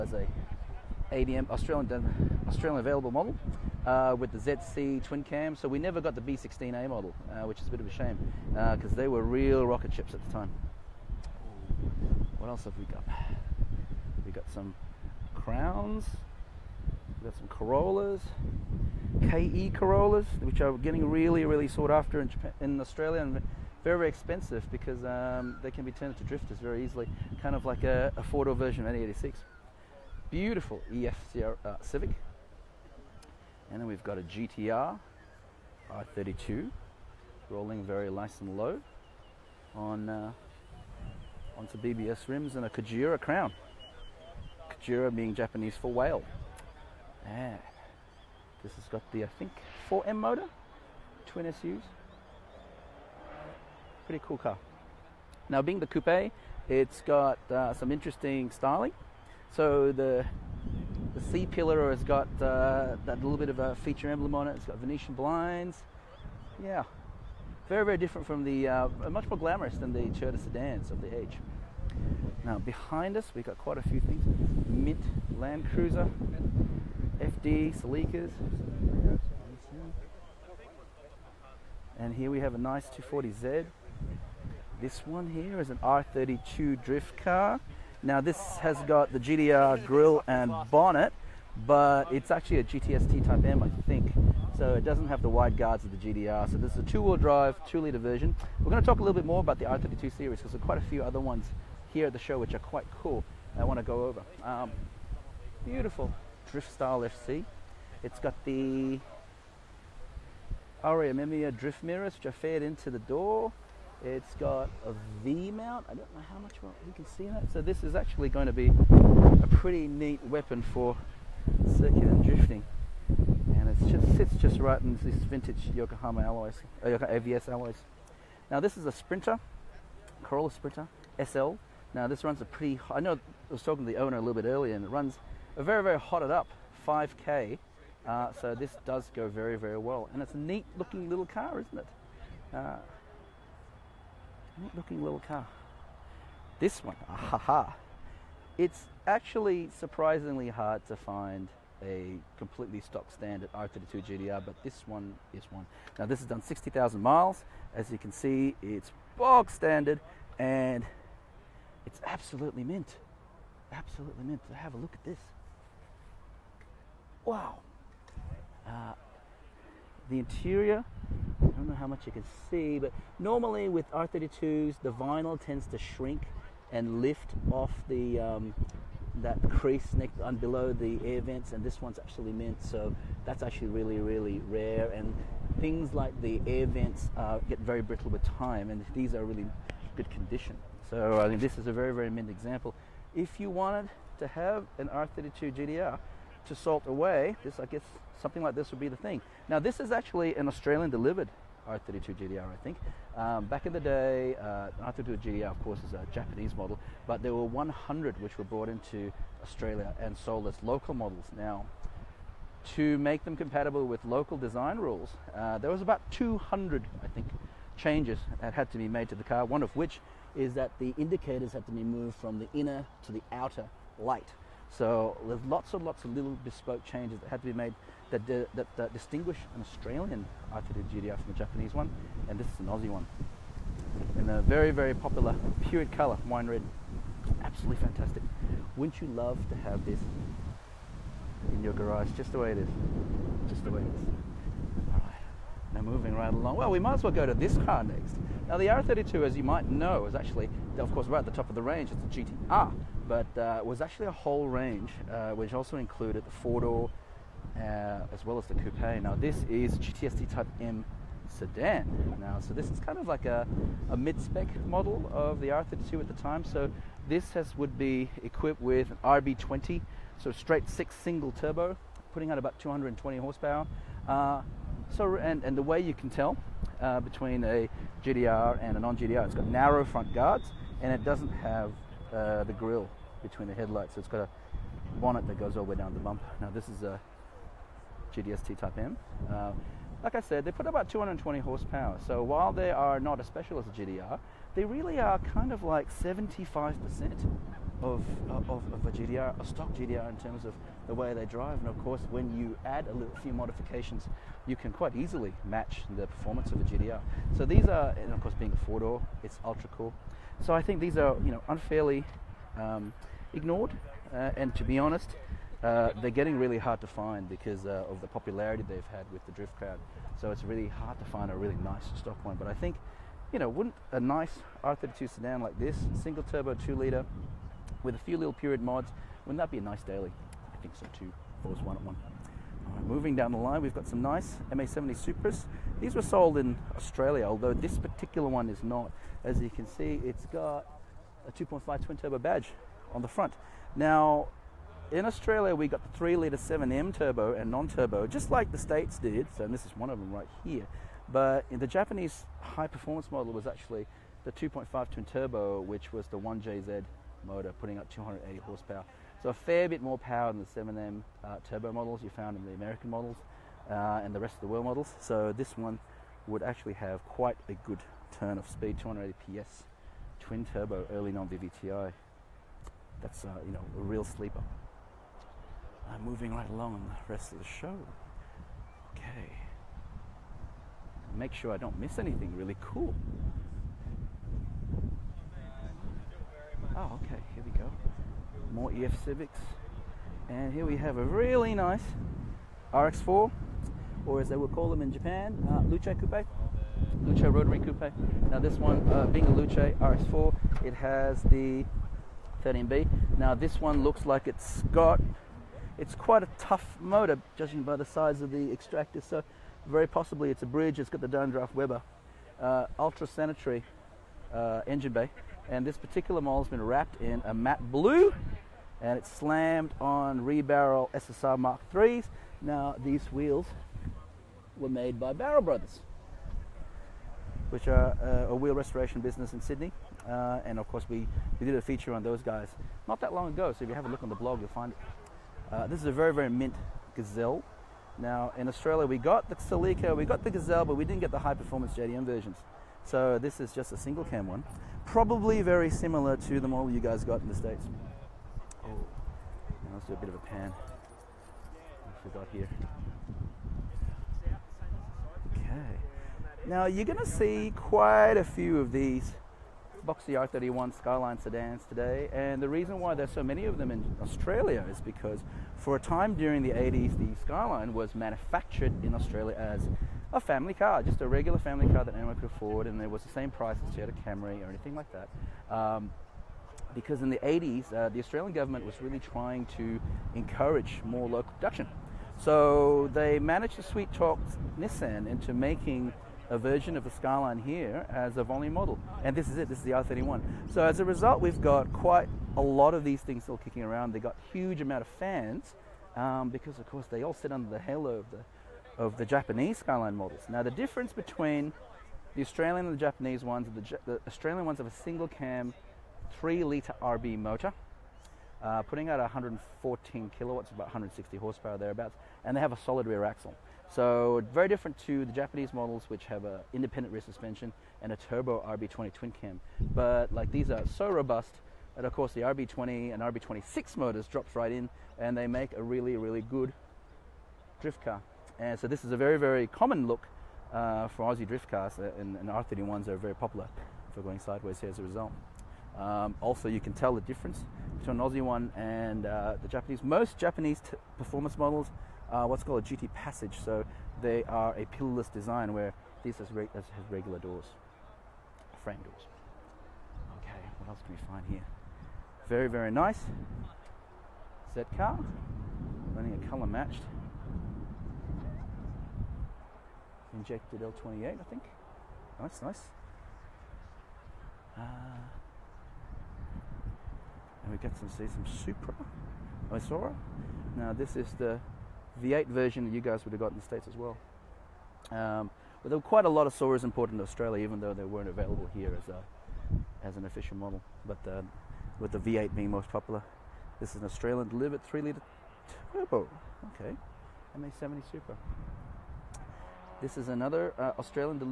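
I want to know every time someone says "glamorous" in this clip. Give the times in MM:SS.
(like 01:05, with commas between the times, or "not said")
01:09.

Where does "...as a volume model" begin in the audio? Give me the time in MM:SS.
08:07.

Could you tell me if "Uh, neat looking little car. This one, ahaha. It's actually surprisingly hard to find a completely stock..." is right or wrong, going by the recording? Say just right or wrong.
right.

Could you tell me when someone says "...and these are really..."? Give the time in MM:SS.
03:08.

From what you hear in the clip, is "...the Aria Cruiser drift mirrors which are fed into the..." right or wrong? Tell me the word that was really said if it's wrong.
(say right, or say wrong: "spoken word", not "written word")
wrong: "Mimia", not "Cruiser".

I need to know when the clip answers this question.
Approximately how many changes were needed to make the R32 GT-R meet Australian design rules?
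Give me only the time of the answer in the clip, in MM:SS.
03:36.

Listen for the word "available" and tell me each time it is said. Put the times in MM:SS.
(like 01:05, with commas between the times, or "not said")
00:02, 09:38.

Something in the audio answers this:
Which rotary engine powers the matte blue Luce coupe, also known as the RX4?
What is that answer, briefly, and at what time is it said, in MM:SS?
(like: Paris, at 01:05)
13B, at 06:42.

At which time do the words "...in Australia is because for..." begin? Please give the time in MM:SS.
07:43.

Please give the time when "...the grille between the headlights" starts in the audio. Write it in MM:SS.
04:42.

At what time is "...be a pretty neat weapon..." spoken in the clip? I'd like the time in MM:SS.
01:58.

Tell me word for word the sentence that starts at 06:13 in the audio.
That's uh, you know a real sleeper.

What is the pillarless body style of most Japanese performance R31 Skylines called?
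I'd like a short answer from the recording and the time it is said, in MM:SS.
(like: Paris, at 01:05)
GT passage, at 09:02.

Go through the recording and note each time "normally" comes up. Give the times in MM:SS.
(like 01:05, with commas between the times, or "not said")
02:53.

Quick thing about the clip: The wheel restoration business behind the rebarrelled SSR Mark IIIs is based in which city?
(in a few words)
Sydney.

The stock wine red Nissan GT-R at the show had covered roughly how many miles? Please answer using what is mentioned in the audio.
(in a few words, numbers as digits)
60,000 miles.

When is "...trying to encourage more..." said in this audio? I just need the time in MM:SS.
07:58.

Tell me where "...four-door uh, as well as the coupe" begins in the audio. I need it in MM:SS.
04:16.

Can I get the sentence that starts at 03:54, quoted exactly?
And a very, very popular period color, wine red.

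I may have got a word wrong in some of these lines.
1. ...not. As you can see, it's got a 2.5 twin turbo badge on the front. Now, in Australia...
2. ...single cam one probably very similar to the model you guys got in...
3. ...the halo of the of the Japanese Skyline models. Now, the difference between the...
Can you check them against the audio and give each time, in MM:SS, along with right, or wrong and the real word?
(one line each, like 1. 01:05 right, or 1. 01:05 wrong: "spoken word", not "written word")
1. 05:38 right
2. 07:23 right
3. 08:17 right.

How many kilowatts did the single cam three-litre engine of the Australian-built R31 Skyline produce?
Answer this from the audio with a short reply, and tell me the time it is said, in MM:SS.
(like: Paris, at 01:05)
114 kilowatts, at 08:28.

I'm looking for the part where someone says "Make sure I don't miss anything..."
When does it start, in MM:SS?
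06:21.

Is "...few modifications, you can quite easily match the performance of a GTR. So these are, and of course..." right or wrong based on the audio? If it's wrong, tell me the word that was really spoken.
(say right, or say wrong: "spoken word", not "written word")
right.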